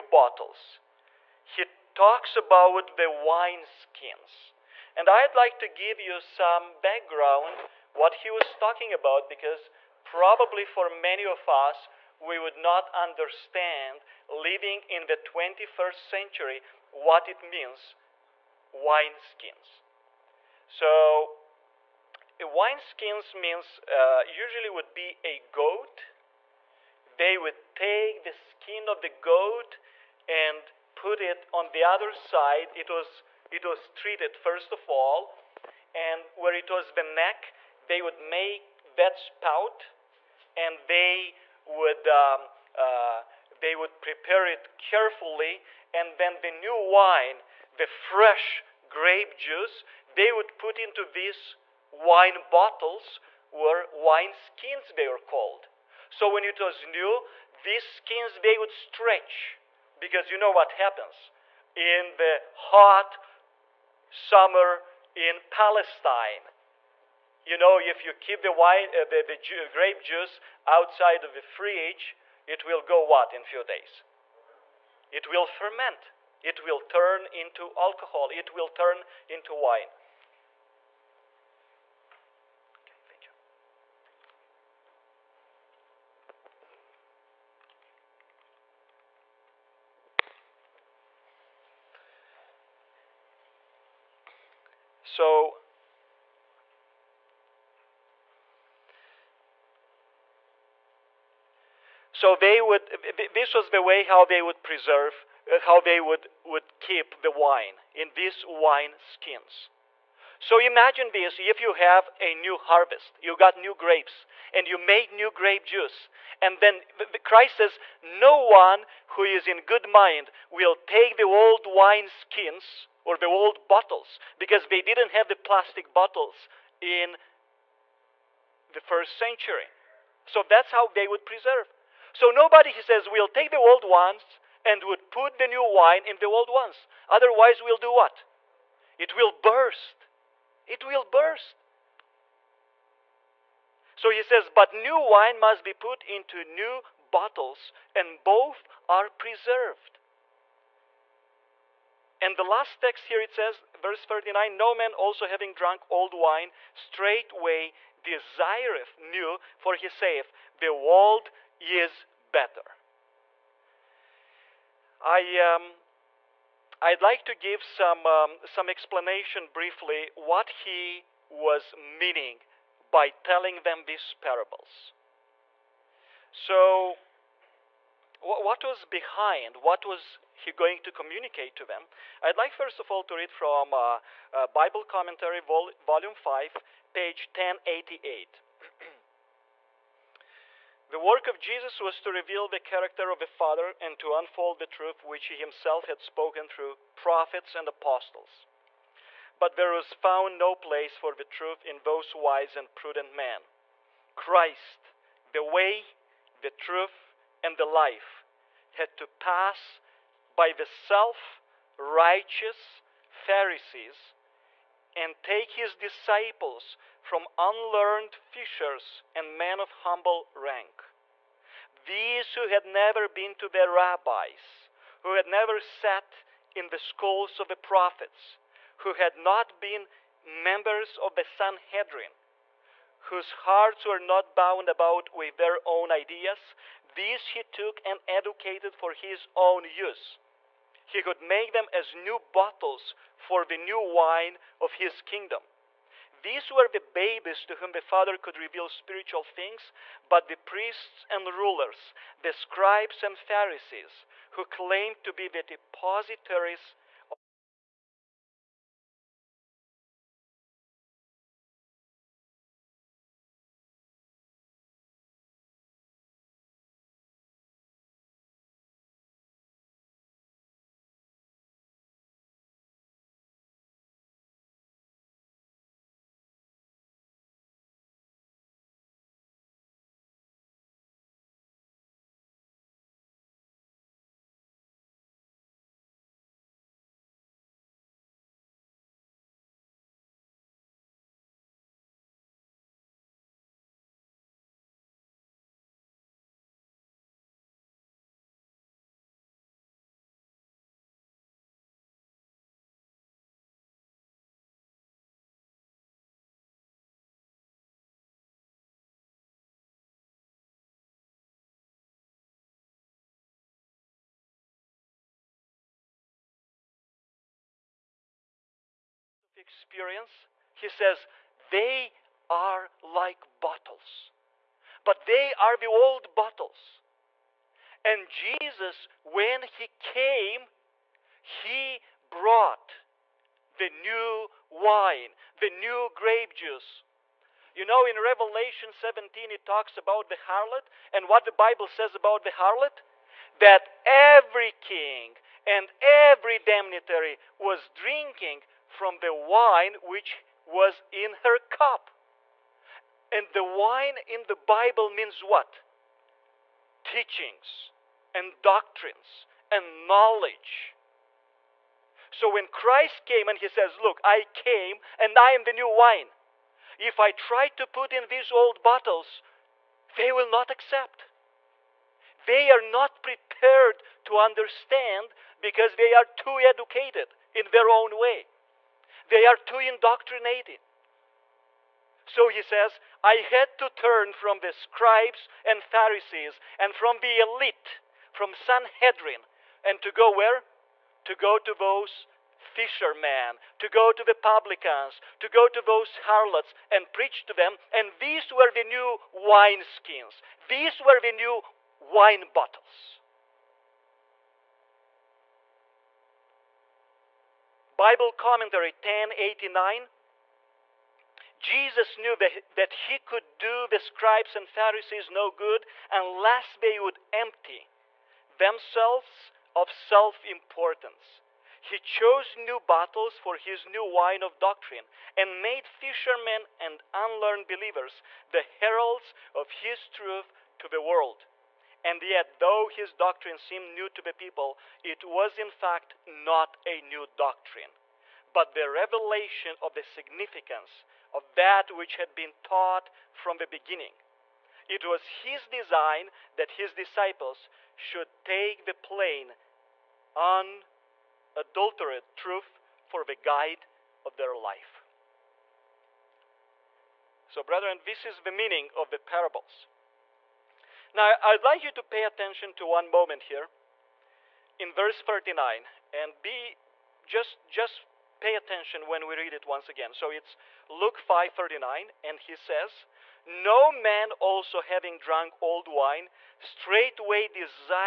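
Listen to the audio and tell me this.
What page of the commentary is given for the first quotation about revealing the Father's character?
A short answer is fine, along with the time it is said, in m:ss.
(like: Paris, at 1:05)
1088, at 3:06.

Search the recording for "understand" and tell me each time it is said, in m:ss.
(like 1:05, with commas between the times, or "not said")
0:12, 6:14.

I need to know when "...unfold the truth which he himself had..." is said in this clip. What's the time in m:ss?
3:14.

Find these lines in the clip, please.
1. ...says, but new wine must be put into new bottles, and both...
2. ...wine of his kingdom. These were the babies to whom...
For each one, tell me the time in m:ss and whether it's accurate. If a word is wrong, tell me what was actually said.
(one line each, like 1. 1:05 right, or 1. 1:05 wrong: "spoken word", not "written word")
1. 2:24 right
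2. 4:03 right.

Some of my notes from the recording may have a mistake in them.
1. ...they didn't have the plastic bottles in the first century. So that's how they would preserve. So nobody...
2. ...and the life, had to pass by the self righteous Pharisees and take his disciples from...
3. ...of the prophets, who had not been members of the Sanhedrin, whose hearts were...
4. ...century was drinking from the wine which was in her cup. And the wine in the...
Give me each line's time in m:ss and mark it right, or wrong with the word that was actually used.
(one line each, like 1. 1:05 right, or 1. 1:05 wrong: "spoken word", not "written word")
1. 2:04 right
2. 3:27 right
3. 3:47 right
4. 5:46 wrong: "damnatary", not "century".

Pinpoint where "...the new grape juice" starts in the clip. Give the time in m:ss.
5:35.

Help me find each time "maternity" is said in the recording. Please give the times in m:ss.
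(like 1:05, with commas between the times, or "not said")
not said.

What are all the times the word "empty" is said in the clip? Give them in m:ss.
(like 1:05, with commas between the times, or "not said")
6:57.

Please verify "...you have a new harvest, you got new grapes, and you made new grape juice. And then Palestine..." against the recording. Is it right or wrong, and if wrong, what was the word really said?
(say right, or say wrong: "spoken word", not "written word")
wrong: "Christ", not "Palestine".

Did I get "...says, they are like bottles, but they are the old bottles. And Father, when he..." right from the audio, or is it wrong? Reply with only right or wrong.
wrong.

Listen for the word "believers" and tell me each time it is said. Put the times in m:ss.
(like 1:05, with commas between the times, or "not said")
7:07.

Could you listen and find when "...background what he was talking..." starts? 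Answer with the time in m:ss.
0:06.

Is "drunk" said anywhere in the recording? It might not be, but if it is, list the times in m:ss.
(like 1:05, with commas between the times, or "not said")
2:35, 7:54.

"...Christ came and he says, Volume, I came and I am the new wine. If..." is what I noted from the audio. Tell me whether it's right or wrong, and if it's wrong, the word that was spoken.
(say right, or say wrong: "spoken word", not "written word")
wrong: "Look", not "Volume".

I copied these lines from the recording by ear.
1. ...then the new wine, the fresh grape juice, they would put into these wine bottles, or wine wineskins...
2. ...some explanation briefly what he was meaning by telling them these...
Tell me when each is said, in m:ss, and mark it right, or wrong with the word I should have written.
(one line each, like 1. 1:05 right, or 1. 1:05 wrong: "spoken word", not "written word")
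1. 0:46 wrong: "skins", not "wineskins"
2. 2:48 right.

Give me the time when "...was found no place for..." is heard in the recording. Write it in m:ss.
3:19.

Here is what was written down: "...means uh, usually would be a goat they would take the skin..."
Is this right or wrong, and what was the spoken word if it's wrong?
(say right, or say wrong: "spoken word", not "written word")
right.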